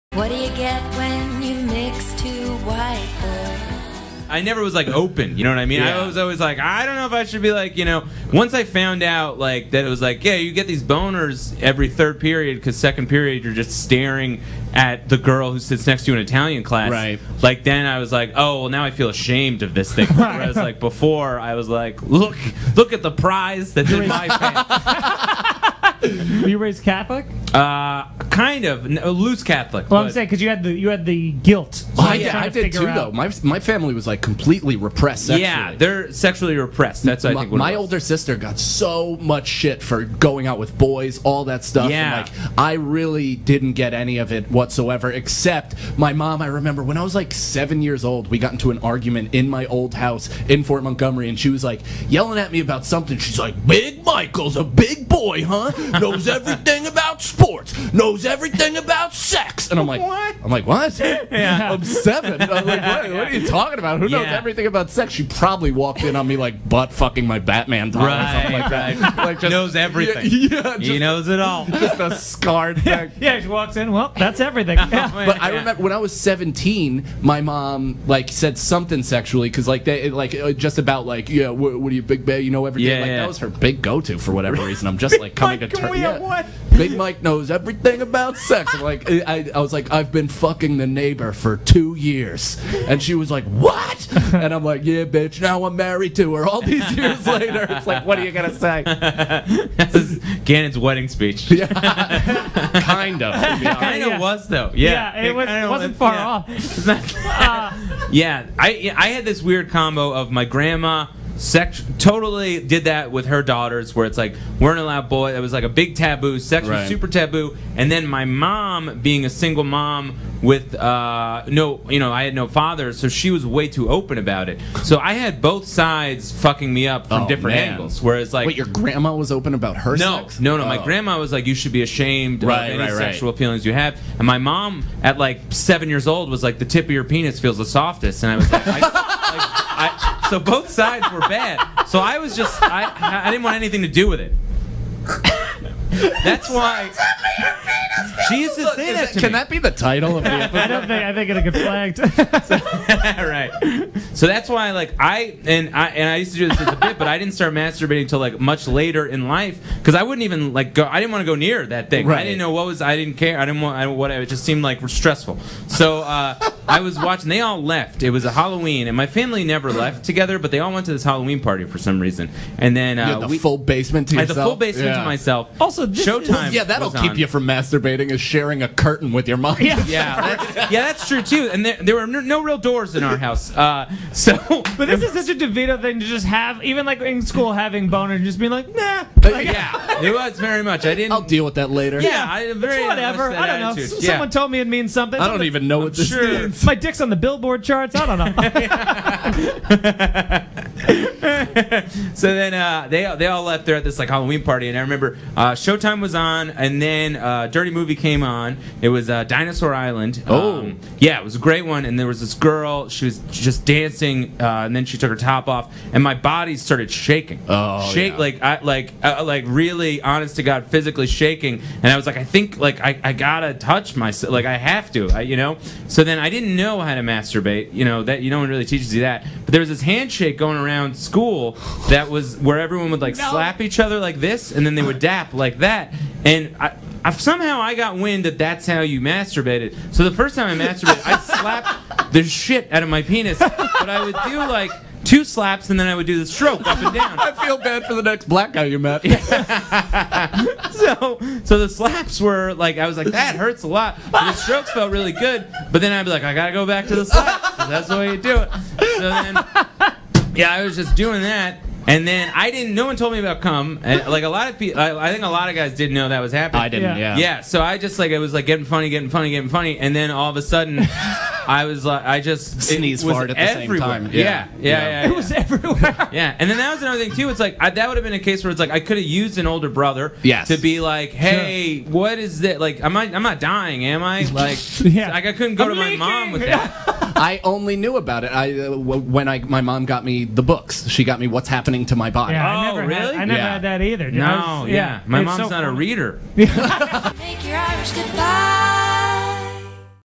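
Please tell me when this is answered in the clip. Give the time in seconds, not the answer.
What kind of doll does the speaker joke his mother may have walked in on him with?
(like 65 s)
67 s.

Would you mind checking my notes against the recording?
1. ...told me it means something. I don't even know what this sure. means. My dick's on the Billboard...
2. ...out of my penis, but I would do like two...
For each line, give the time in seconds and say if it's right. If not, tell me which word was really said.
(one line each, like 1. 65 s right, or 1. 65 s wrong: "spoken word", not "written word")
1. 194 s right
2. 242 s right.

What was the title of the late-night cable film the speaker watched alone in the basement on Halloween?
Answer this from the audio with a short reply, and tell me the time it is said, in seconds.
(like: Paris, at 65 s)
Dinosaur Island, at 209 s.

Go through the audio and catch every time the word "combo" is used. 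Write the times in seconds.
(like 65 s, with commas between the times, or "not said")
109 s.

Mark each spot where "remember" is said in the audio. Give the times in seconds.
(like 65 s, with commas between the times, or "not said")
46 s, 75 s, 204 s.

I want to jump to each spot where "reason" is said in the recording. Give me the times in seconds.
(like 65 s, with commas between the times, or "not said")
84 s, 171 s.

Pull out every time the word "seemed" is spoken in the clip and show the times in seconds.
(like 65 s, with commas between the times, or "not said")
164 s.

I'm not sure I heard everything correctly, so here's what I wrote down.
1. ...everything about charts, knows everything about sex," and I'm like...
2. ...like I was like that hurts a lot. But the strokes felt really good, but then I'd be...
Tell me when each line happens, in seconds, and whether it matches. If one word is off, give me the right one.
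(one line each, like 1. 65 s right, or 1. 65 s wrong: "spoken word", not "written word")
1. 56 s wrong: "sports", not "charts"
2. 252 s right.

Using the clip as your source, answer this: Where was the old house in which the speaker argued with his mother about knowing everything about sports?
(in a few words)
Fort Montgomery.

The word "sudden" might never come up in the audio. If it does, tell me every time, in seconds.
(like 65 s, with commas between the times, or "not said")
270 s.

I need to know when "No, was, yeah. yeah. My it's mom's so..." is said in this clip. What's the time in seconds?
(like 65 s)
294 s.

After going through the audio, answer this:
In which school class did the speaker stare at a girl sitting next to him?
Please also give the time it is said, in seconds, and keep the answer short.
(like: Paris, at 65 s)
Italian class, at 16 s.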